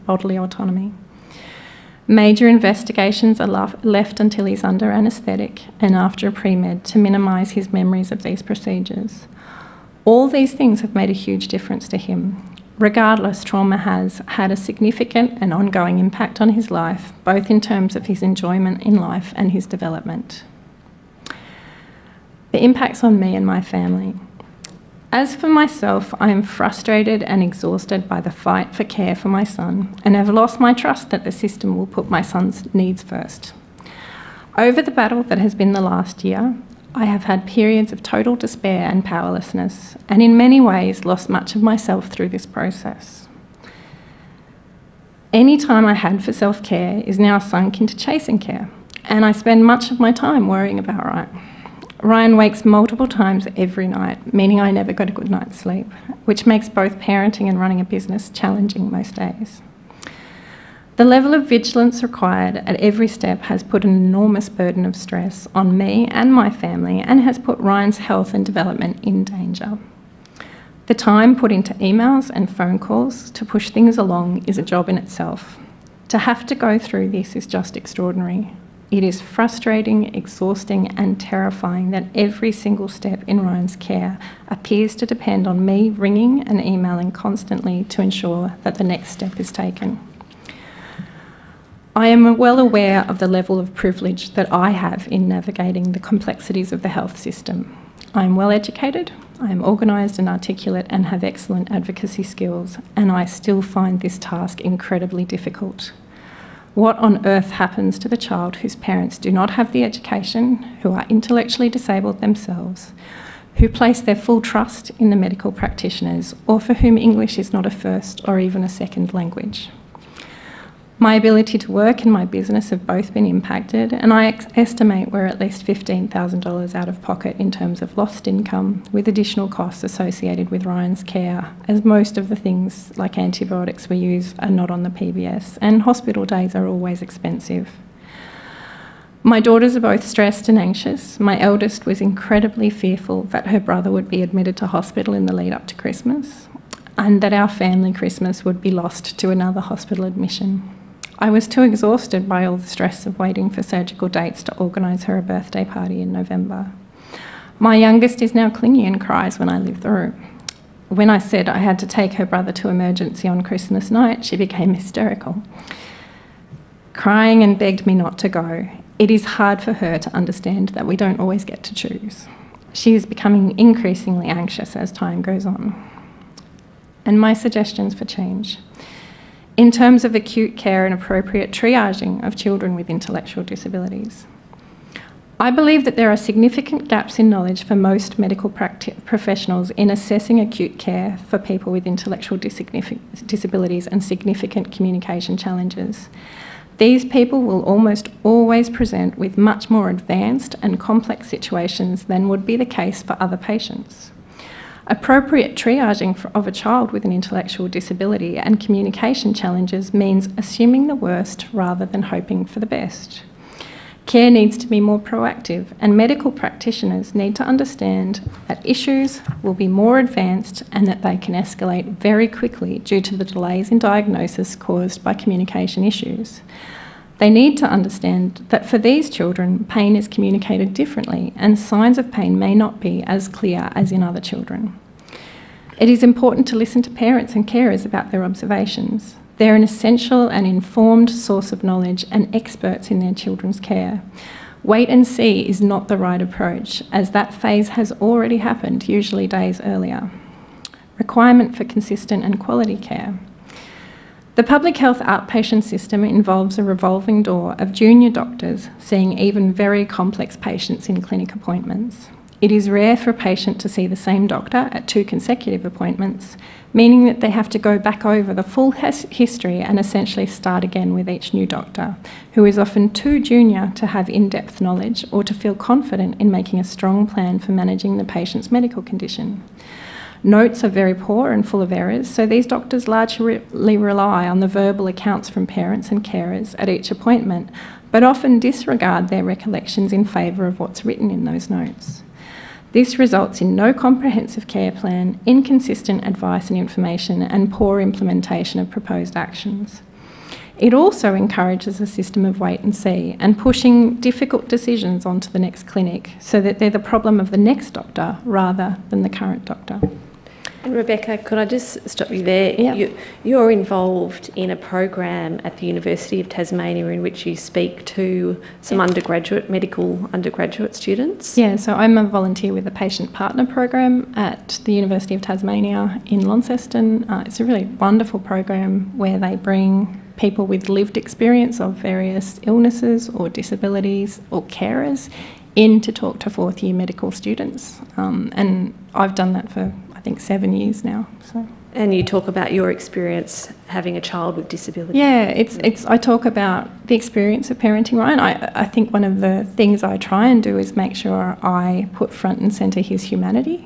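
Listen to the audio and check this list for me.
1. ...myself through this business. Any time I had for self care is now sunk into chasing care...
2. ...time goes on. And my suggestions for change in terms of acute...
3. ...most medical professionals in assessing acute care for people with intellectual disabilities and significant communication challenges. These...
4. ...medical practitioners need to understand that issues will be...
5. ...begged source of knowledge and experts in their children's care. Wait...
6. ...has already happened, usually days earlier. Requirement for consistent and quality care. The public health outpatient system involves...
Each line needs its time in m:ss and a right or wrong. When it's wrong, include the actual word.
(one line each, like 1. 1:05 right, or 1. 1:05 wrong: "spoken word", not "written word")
1. 0:41 wrong: "process", not "business"
2. 2:54 right
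3. 3:07 right
4. 3:35 right
5. 4:00 wrong: "informed", not "begged"
6. 4:07 right.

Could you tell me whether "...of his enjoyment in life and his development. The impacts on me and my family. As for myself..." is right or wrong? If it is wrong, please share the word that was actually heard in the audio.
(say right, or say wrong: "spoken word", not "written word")
right.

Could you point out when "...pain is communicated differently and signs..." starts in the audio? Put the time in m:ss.
3:49.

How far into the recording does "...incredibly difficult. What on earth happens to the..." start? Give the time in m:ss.
1:44.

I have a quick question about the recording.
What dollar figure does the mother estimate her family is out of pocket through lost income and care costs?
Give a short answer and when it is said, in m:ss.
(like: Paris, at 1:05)
$15,000, at 2:05.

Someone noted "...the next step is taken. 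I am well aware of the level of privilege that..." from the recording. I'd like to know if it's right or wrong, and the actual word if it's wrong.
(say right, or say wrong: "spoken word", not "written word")
right.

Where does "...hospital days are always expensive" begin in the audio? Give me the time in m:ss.
2:15.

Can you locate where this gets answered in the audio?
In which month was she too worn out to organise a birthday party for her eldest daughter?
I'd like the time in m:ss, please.
2:36.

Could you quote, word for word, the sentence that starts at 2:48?
It is hard for her to understand that we don't always get to choose.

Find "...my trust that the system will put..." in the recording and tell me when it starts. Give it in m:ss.
0:30.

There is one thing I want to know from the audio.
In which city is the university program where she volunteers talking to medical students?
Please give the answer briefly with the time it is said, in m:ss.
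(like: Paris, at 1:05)
Launceston, at 5:26.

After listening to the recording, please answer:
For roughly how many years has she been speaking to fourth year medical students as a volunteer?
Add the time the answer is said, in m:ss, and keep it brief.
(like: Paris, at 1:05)
7, at 5:40.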